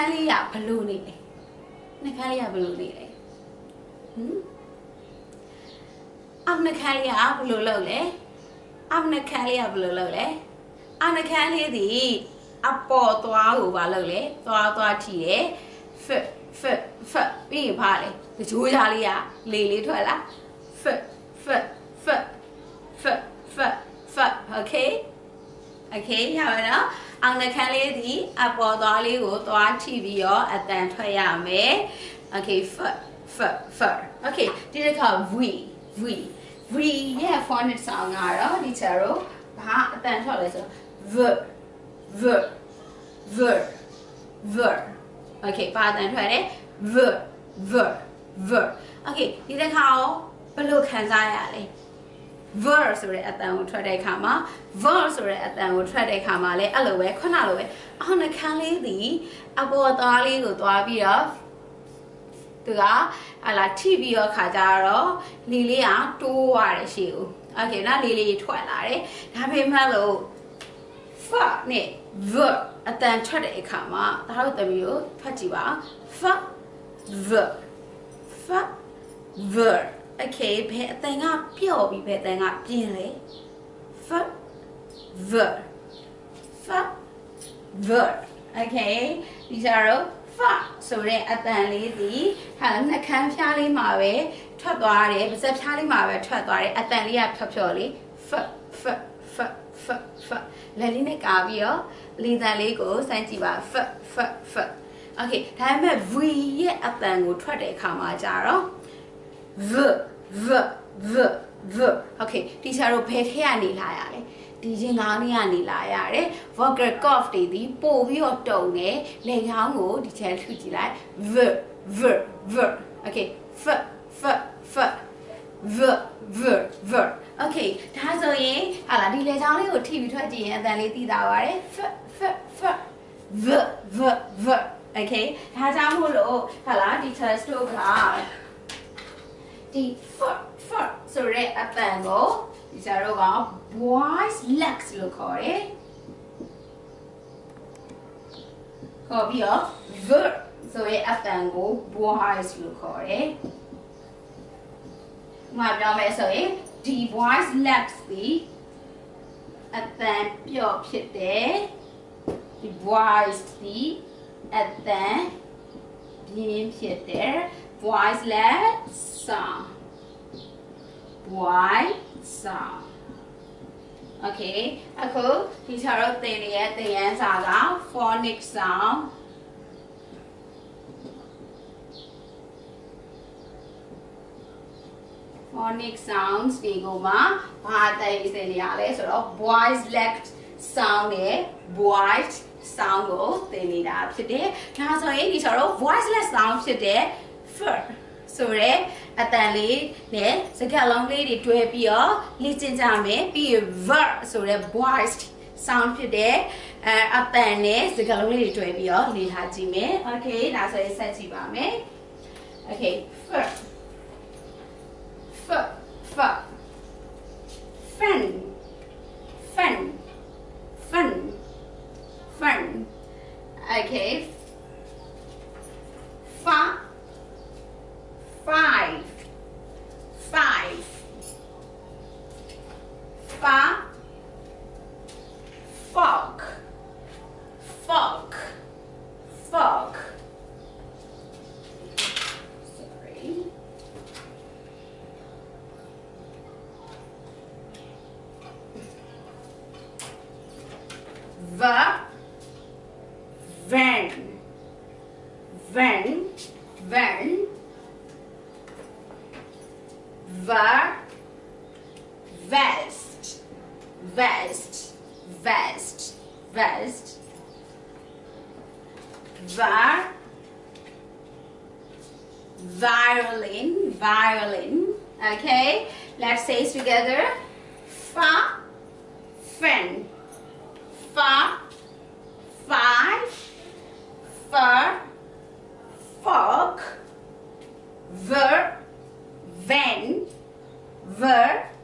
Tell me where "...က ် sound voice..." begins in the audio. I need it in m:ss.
2:48.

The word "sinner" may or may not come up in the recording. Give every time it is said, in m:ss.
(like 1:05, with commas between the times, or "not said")
not said.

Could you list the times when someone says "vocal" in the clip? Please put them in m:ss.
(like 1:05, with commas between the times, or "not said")
1:56.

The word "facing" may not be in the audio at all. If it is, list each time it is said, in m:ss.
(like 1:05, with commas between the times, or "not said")
not said.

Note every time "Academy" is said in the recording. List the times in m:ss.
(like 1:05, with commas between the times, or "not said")
not said.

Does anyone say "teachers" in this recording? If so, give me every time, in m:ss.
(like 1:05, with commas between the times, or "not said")
2:17.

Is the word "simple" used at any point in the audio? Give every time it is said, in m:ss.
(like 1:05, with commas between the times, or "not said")
not said.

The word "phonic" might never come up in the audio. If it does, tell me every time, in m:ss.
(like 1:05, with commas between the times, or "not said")
0:37, 2:57, 3:05.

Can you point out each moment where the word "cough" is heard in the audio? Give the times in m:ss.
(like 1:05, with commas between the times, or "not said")
1:57.